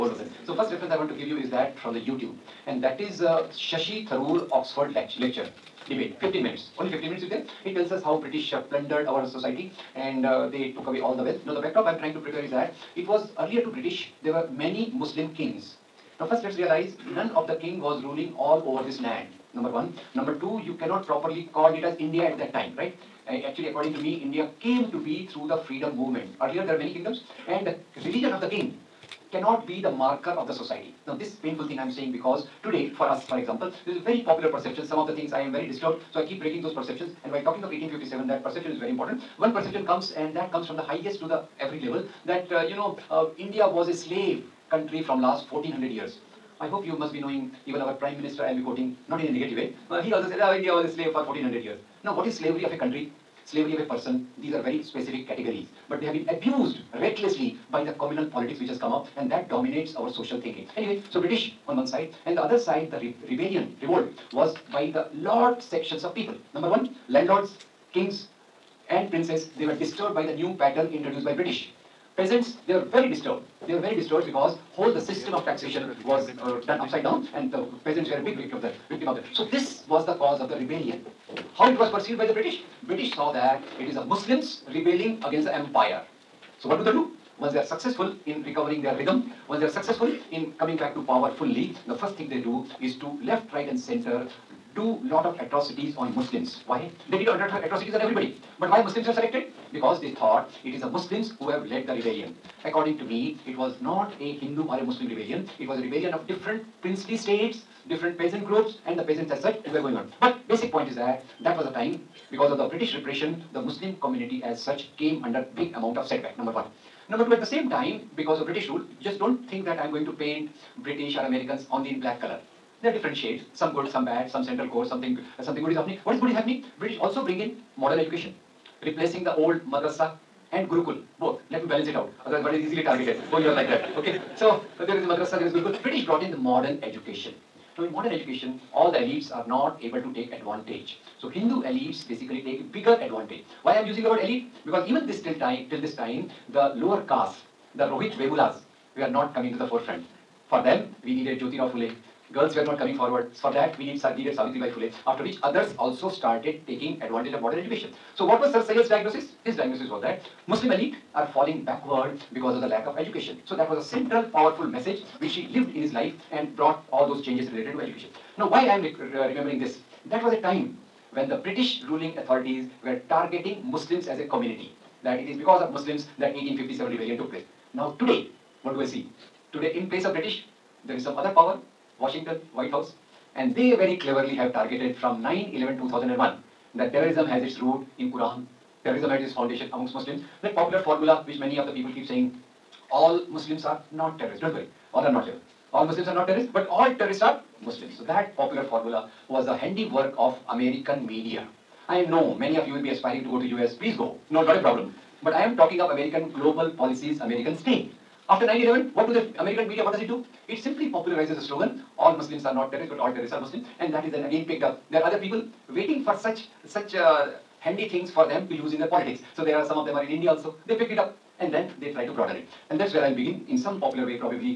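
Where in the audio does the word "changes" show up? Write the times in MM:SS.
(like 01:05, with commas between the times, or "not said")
02:47.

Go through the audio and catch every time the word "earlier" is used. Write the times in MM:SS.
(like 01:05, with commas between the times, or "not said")
00:13, 00:26.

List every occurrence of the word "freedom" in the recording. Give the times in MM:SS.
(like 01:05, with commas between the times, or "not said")
00:25.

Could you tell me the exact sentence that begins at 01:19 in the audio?
So this was the cause of the rebellion.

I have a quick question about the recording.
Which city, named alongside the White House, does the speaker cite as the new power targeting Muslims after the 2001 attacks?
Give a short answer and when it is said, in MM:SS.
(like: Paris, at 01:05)
Washington, at 03:01.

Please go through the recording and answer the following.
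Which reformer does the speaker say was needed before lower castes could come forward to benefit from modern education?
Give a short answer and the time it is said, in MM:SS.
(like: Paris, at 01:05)
Jyotirao Phule, at 02:31.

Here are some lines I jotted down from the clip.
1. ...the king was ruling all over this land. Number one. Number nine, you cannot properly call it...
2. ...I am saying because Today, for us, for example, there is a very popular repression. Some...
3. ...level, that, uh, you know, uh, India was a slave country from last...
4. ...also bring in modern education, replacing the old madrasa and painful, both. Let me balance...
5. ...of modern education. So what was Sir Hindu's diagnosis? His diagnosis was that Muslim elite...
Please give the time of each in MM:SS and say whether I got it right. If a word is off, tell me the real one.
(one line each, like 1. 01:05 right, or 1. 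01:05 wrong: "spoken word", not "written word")
1. 00:17 wrong: "two", not "nine"
2. 00:31 wrong: "perception", not "repression"
3. 00:41 right
4. 02:06 wrong: "gurukul", not "painful"
5. 02:37 wrong: "Syed", not "Hindu".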